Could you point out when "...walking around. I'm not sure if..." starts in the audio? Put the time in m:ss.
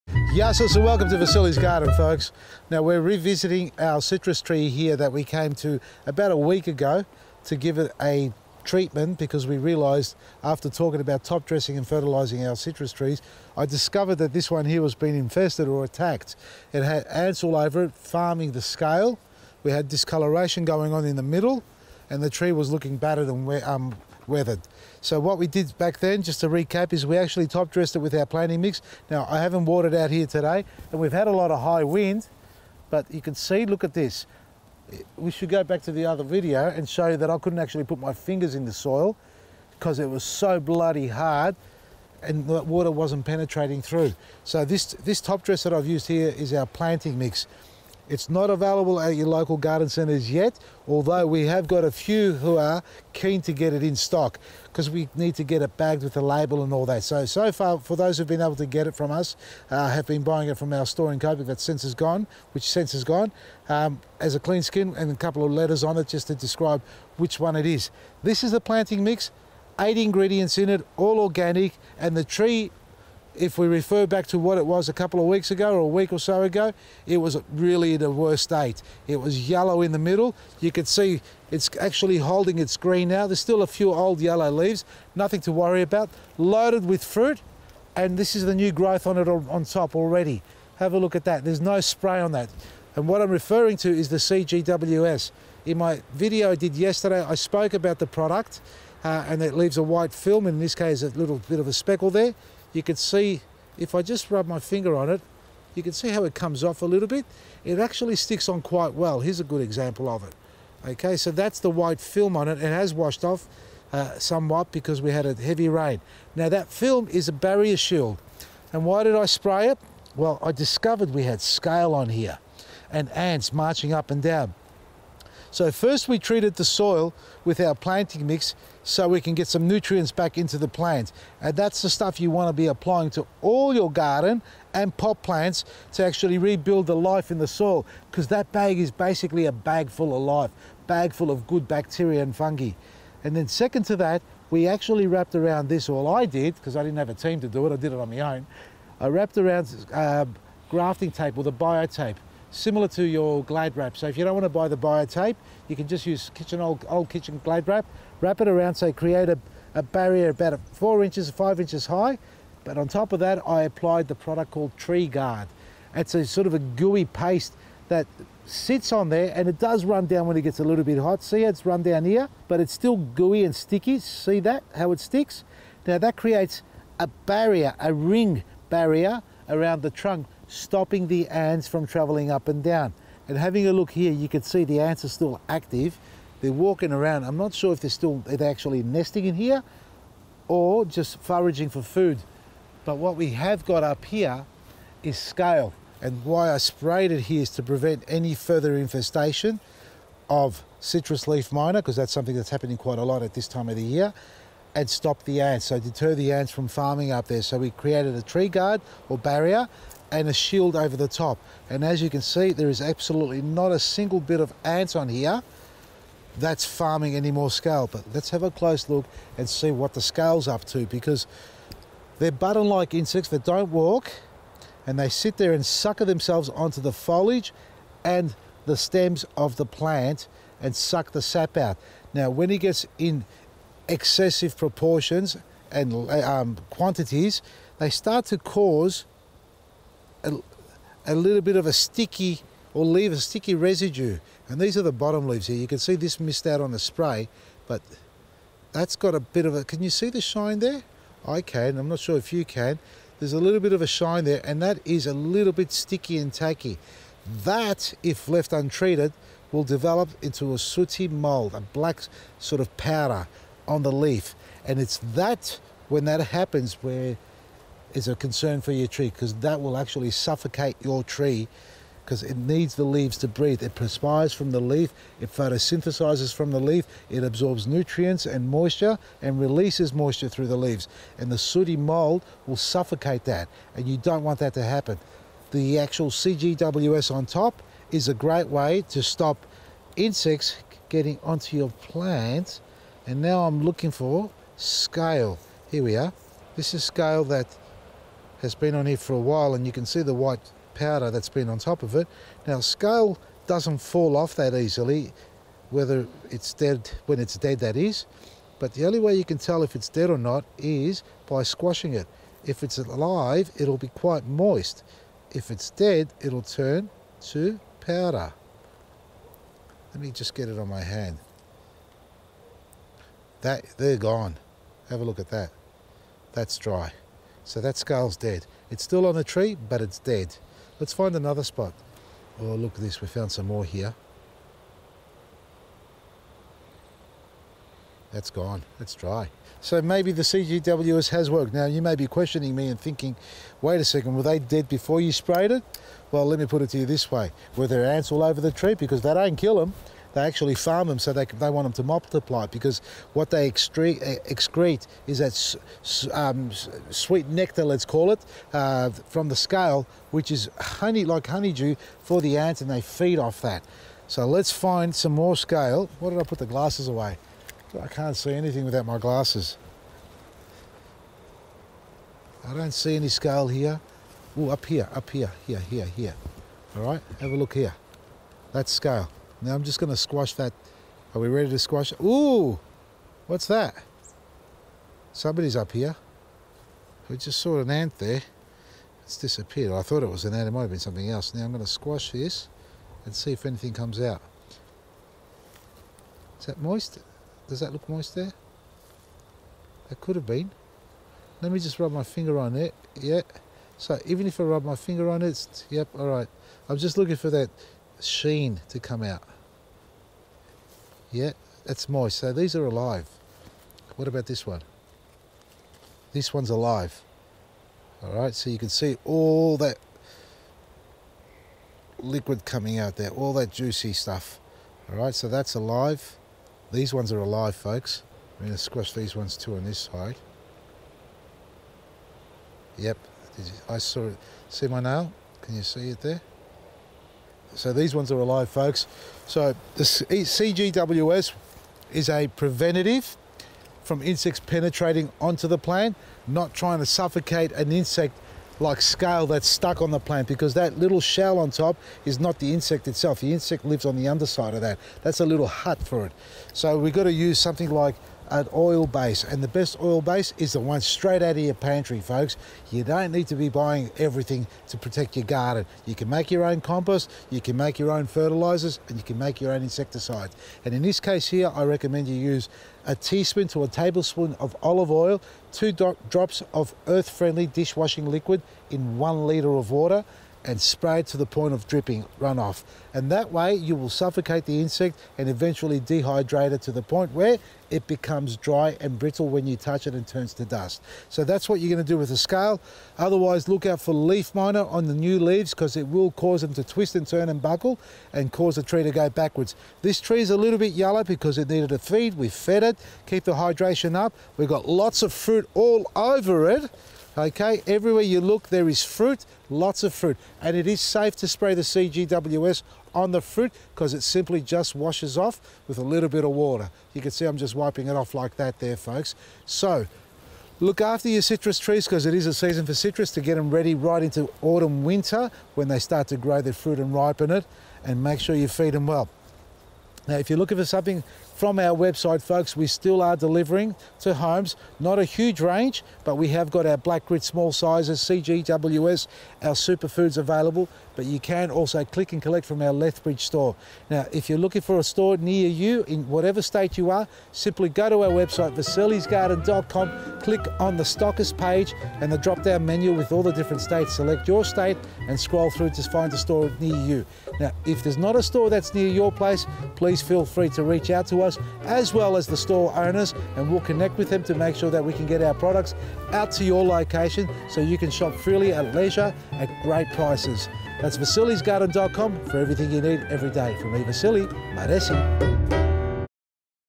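3:06.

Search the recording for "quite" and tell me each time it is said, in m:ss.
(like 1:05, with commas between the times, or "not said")
1:48, 3:22, 5:13.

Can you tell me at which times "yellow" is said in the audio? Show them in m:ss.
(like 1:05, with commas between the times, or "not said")
1:19, 1:24, 8:20.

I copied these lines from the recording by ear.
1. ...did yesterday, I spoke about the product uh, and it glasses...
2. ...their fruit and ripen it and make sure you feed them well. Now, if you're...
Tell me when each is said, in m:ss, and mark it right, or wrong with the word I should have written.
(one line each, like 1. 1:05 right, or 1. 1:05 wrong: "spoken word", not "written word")
1. 1:36 wrong: "leaves", not "glasses"
2. 8:46 right.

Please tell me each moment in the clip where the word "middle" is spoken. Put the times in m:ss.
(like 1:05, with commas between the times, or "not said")
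0:21, 1:19.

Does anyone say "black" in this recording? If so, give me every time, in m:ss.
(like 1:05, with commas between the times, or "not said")
4:21, 8:56.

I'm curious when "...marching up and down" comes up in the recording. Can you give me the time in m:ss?
2:03.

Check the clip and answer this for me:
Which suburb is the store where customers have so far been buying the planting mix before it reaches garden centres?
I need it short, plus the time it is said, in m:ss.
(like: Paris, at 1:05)
Coburg, at 1:01.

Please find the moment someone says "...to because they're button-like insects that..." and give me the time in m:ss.
3:40.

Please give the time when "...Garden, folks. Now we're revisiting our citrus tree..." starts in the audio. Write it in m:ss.
0:01.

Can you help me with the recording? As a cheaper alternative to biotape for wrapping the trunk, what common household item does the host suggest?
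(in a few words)
kitchen glad wrap.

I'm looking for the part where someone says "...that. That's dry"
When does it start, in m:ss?
5:25.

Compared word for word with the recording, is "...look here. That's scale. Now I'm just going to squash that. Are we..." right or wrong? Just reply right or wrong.
right.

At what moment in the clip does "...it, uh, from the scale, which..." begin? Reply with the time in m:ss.
5:58.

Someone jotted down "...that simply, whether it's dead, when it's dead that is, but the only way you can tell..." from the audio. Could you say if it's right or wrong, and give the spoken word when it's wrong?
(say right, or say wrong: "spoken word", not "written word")
wrong: "easily", not "simply".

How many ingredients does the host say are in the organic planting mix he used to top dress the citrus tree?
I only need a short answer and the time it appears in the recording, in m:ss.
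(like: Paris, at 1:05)
8, at 1:09.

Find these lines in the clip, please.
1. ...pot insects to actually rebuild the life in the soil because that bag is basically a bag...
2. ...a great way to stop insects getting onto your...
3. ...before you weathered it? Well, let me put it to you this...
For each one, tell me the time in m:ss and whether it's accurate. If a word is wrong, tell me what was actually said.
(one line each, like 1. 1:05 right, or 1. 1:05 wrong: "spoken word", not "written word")
1. 2:14 wrong: "plants", not "insects"
2. 4:48 right
3. 5:44 wrong: "sprayed", not "weathered".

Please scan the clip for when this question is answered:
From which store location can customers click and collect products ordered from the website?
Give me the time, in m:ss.
9:02.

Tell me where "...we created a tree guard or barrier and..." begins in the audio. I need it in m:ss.
3:27.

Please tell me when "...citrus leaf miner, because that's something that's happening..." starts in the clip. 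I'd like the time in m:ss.
3:20.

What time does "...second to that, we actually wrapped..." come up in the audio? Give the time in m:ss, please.
2:23.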